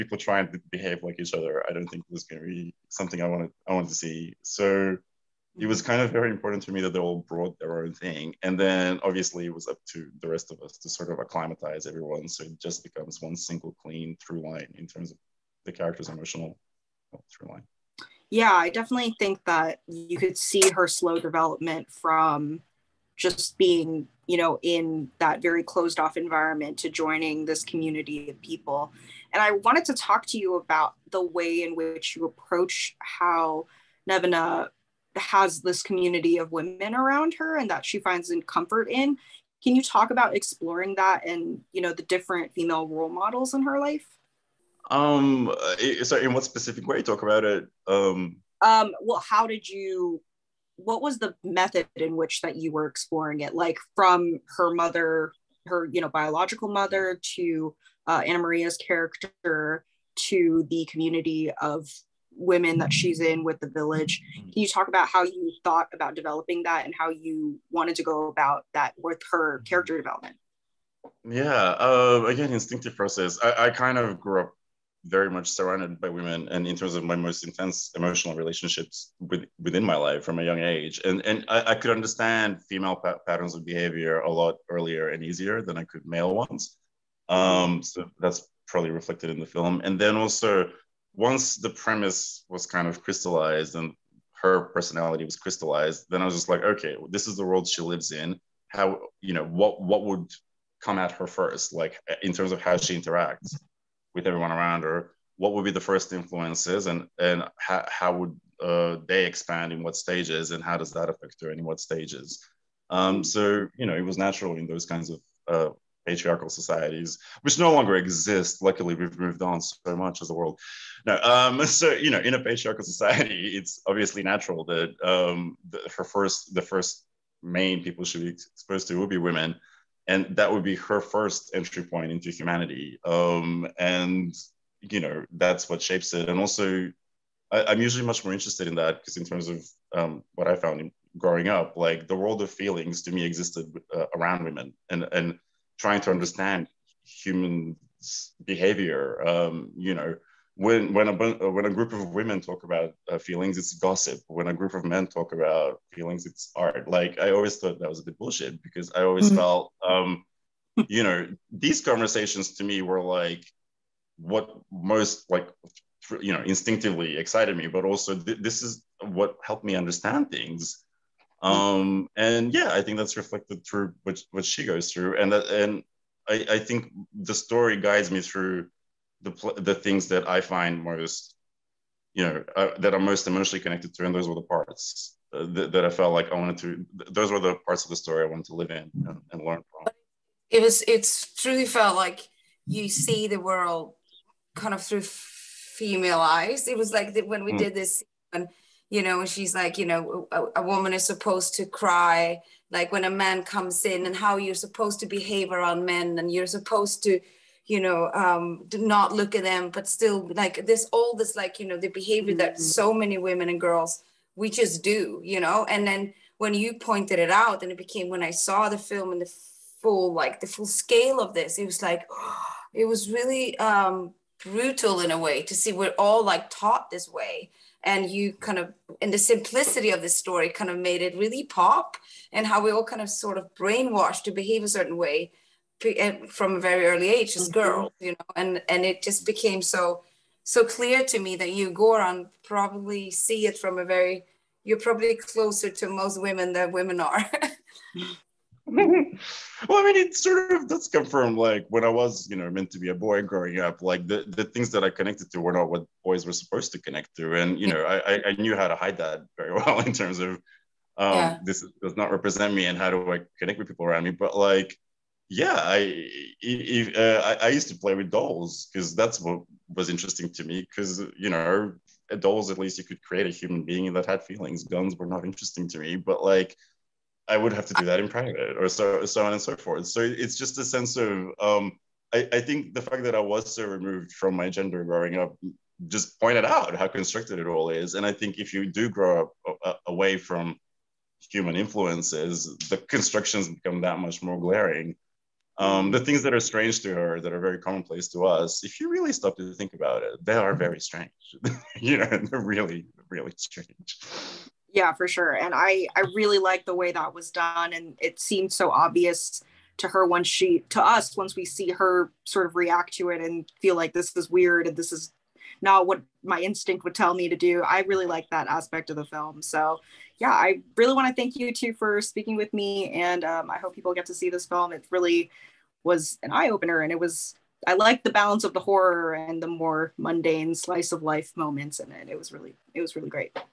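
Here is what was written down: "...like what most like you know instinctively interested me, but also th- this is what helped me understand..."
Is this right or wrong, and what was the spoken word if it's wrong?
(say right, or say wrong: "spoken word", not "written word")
wrong: "excited", not "interested".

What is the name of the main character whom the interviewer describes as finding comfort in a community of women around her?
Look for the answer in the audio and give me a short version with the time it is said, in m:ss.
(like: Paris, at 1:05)
Nevena, at 0:34.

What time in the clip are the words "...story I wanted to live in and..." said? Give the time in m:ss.
3:07.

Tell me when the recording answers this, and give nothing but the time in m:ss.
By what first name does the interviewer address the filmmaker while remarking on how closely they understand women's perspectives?
4:01.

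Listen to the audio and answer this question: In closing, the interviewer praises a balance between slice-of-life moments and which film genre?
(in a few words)
horror.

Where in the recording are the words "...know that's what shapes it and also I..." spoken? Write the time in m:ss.
2:14.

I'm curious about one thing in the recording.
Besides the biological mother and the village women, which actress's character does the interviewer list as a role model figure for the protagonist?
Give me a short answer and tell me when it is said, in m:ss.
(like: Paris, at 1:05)
Anamaria, at 0:58.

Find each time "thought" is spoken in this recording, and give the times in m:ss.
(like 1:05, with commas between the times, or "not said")
1:05, 2:37.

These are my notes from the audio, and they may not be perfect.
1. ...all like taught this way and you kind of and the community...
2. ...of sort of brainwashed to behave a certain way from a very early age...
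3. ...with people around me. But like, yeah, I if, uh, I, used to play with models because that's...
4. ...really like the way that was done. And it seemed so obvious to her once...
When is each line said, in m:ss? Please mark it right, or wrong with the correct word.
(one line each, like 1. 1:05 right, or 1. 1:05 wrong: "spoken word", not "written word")
1. 3:45 wrong: "simplicity", not "community"
2. 3:53 right
3. 4:23 wrong: "dolls", not "models"
4. 5:06 right.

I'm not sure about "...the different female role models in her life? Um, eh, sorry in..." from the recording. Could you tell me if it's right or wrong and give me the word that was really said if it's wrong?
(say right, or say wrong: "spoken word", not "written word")
right.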